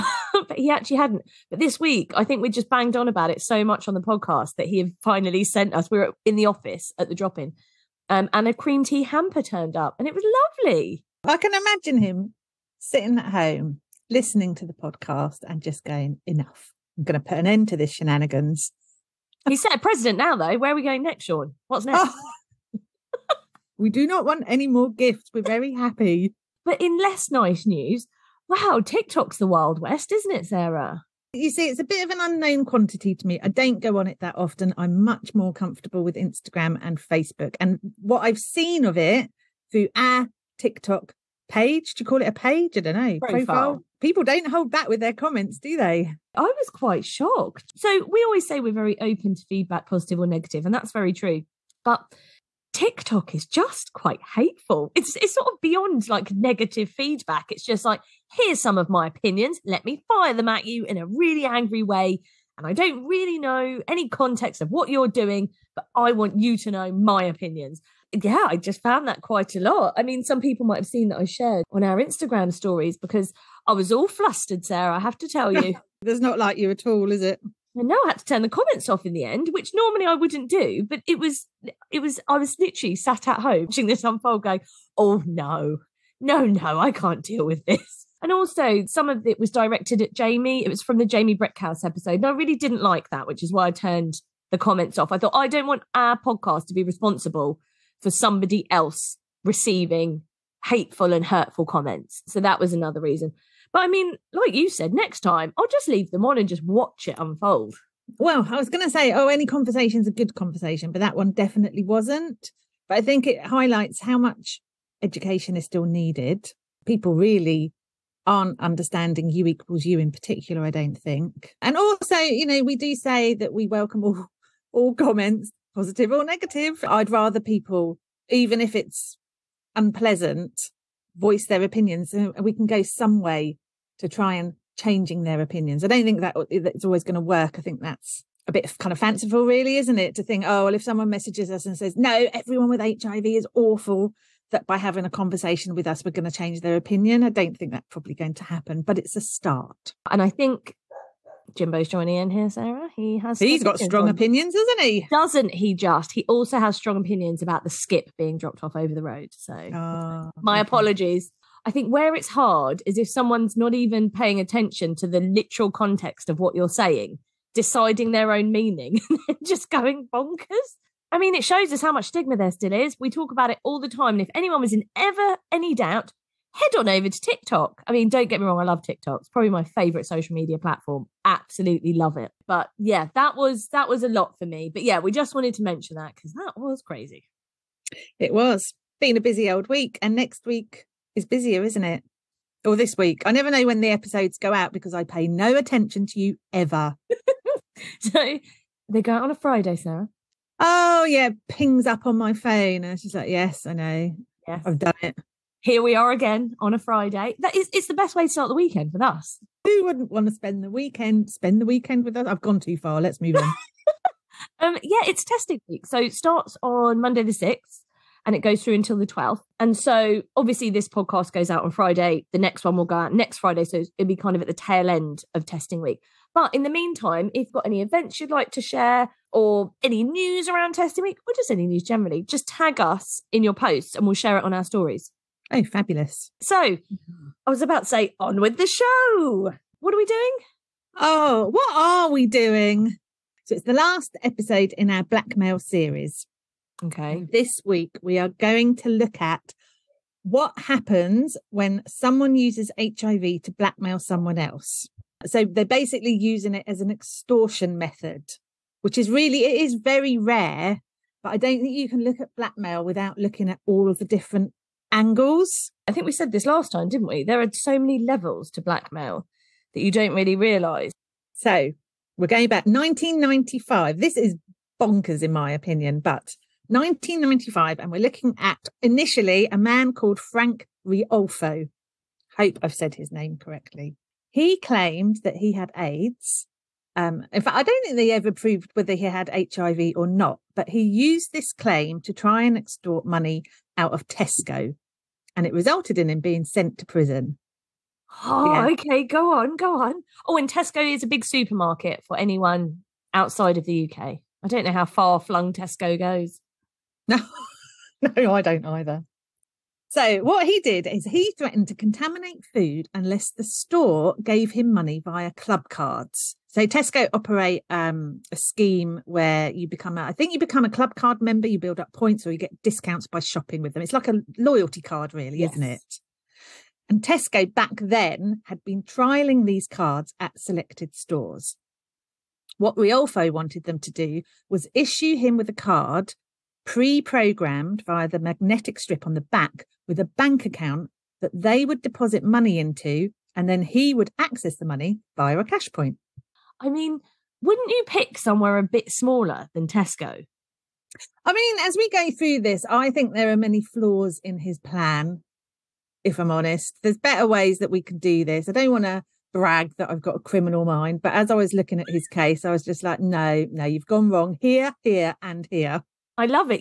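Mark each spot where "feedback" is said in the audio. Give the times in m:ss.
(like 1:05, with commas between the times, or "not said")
0:49, 0:56.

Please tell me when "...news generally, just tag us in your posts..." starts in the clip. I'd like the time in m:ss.
3:51.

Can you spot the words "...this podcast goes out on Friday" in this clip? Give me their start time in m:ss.
3:40.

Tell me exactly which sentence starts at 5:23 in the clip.
It's like a loyalty card, really, yes.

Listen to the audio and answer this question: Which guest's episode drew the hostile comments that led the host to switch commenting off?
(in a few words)
Jamie Breckhouse.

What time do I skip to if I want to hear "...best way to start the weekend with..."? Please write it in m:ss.
3:27.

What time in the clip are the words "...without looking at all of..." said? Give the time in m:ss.
4:22.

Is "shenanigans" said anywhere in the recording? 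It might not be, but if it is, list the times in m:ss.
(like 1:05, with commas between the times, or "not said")
0:17.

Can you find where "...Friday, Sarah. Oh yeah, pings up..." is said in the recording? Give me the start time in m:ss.
3:19.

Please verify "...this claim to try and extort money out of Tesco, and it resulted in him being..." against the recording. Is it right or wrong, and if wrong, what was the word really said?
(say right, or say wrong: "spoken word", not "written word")
right.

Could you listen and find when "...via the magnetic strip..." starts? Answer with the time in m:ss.
5:37.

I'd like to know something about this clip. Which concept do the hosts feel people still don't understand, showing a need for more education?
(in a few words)
U equals U.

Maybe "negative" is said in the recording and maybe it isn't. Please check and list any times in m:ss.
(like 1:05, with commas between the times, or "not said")
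0:50, 0:56, 2:06.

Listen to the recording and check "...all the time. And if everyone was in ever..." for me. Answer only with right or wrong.
wrong.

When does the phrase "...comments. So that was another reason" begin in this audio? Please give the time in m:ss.
1:41.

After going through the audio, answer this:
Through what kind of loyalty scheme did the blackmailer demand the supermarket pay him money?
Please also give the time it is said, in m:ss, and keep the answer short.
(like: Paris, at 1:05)
Club cards, at 5:15.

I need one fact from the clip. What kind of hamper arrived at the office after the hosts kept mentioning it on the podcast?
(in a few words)
Cream tea hamper.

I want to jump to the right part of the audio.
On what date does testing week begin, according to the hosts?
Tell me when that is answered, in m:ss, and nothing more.
3:37.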